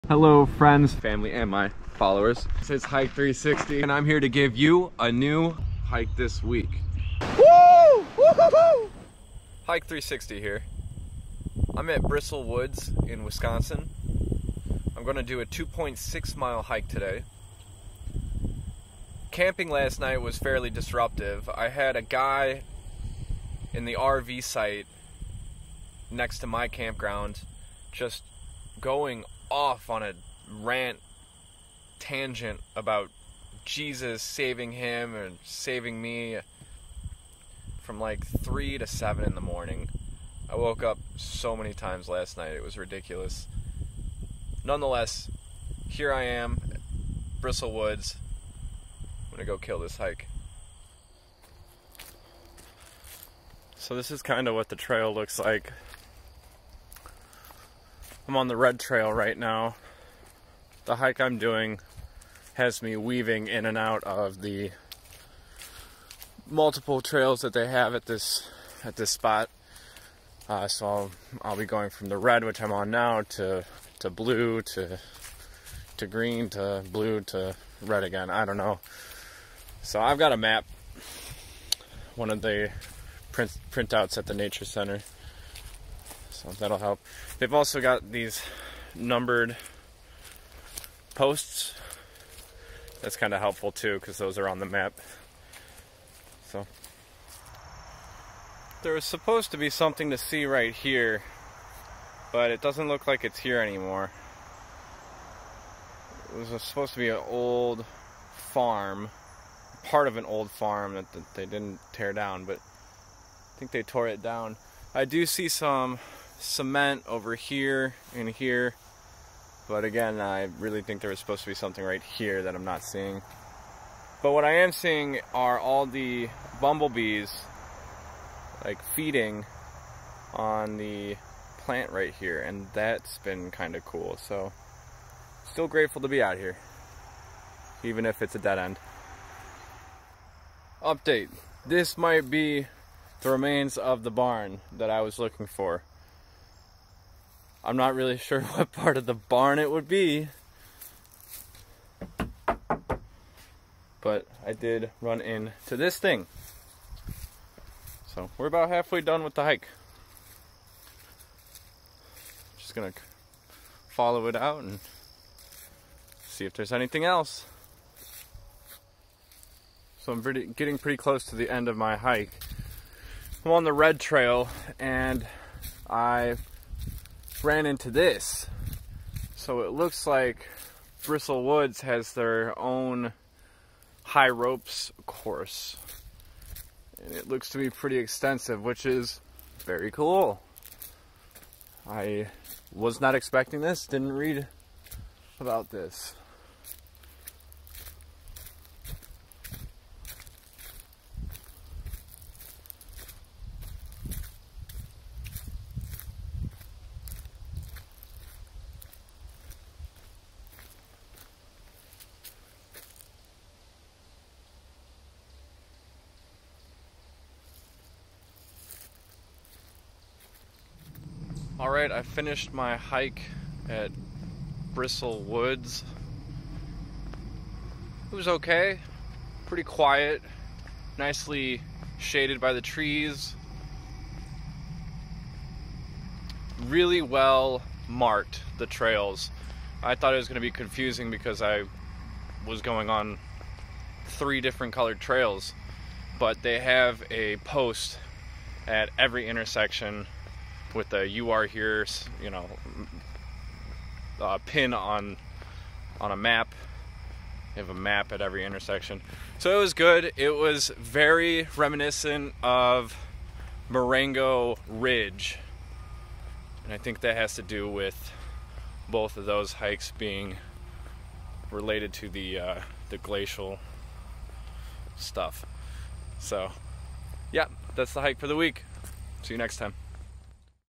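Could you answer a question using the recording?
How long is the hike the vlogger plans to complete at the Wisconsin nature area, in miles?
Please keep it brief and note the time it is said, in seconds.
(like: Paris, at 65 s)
2.6 miles, at 15 s.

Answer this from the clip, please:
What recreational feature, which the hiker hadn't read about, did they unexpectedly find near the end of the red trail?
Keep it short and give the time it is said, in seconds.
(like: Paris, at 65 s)
High ropes course, at 184 s.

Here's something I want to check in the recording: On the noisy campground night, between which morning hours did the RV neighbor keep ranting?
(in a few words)
3 to 7.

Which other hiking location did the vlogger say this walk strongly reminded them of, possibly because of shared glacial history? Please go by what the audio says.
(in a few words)
Marengo Ridge.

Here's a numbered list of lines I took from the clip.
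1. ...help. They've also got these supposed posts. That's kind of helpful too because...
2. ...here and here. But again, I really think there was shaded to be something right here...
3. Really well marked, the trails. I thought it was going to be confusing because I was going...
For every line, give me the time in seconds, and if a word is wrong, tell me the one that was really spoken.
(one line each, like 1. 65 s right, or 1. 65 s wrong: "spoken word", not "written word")
1. 86 s wrong: "numbered", not "supposed"
2. 117 s wrong: "supposed", not "shaded"
3. 236 s right.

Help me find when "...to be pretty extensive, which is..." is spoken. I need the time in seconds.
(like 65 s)
187 s.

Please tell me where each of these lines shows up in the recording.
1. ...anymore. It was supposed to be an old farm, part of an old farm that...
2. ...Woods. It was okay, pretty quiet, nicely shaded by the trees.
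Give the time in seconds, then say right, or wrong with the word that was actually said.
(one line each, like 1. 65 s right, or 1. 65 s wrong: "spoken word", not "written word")
1. 103 s right
2. 225 s right.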